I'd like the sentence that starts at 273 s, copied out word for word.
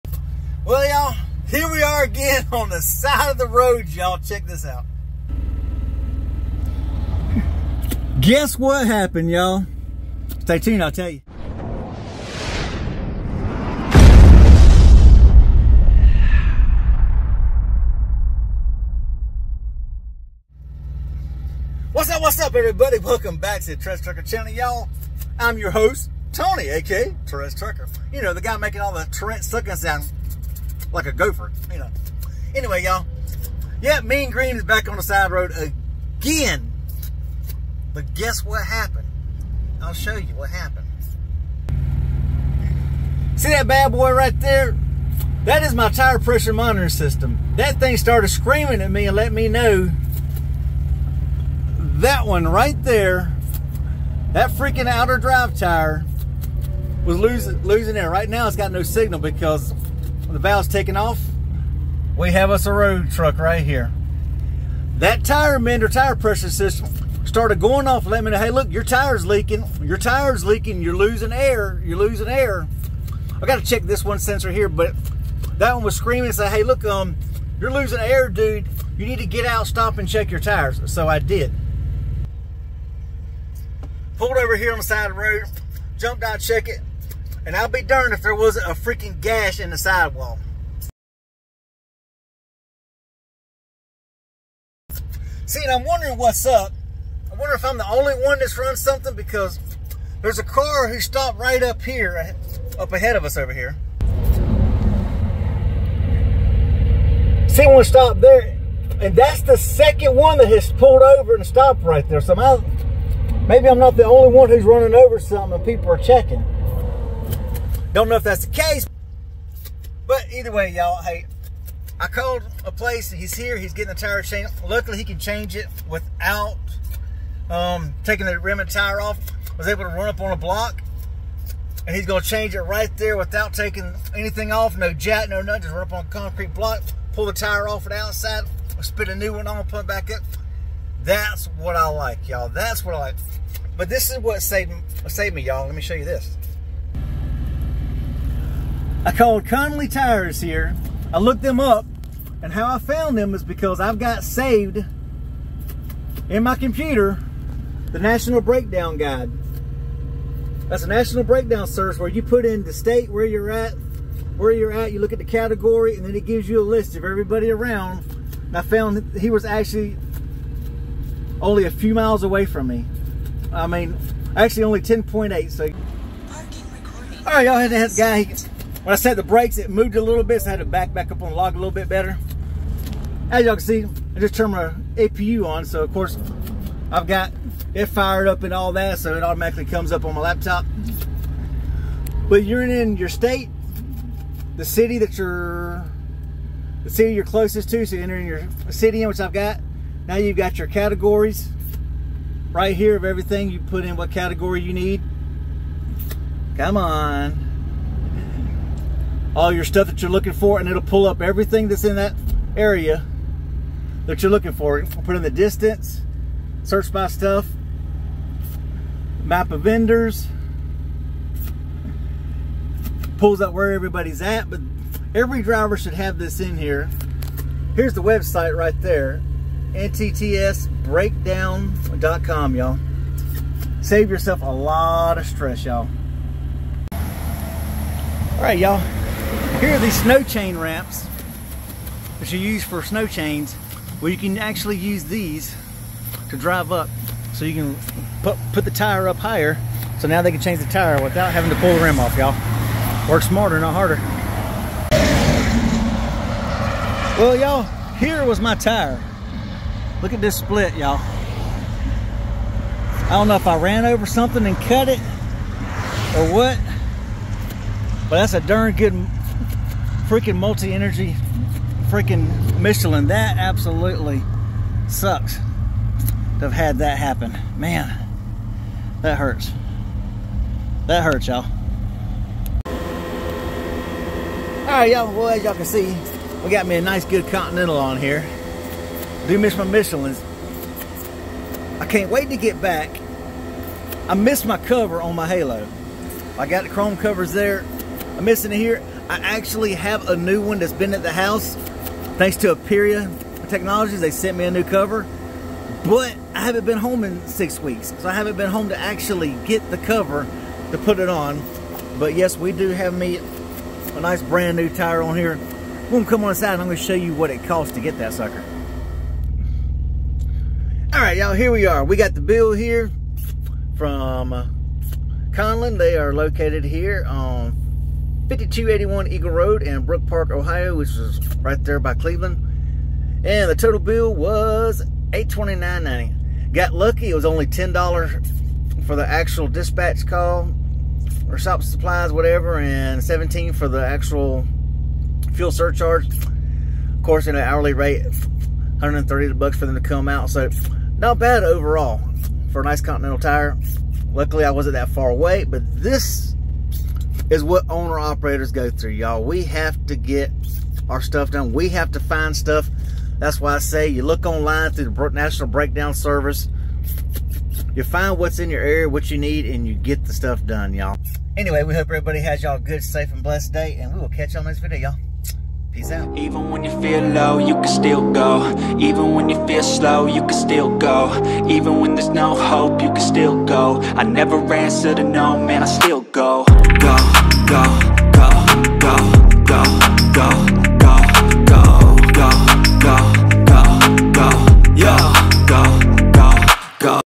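That absolutely sucks to have had that happen.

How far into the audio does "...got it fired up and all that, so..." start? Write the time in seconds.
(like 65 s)
187 s.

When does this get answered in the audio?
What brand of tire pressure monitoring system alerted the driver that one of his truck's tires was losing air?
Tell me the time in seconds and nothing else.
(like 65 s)
65 s.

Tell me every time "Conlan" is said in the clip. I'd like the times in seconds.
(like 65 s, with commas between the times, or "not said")
149 s, 325 s.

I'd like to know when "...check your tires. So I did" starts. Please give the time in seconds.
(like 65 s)
80 s.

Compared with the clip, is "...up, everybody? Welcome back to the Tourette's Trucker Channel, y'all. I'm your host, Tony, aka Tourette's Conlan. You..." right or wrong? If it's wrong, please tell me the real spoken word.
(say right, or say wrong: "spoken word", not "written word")
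wrong: "Trucker", not "Conlan".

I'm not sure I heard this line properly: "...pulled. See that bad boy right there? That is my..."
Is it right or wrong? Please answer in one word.
wrong.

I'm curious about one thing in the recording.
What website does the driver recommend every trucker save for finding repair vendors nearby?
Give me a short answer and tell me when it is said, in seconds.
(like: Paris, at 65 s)
NTTSBreakdown.com, at 229 s.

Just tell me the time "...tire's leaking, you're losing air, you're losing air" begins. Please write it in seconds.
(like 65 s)
69 s.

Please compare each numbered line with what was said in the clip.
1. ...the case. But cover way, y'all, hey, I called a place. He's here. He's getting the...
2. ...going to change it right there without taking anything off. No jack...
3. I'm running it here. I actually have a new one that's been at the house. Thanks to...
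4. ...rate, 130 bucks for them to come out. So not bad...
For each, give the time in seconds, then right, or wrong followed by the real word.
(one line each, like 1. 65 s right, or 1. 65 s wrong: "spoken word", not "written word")
1. 118 s wrong: "either", not "cover"
2. 132 s right
3. 298 s wrong: "missing", not "running"
4. 347 s right.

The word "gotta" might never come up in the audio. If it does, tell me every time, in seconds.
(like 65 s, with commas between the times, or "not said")
73 s.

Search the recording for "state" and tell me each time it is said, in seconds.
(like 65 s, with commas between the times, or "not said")
162 s, 193 s.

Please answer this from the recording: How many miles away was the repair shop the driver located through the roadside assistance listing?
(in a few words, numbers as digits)
10.8.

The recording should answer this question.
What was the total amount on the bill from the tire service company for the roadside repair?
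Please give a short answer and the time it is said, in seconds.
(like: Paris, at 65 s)
$829.90, at 335 s.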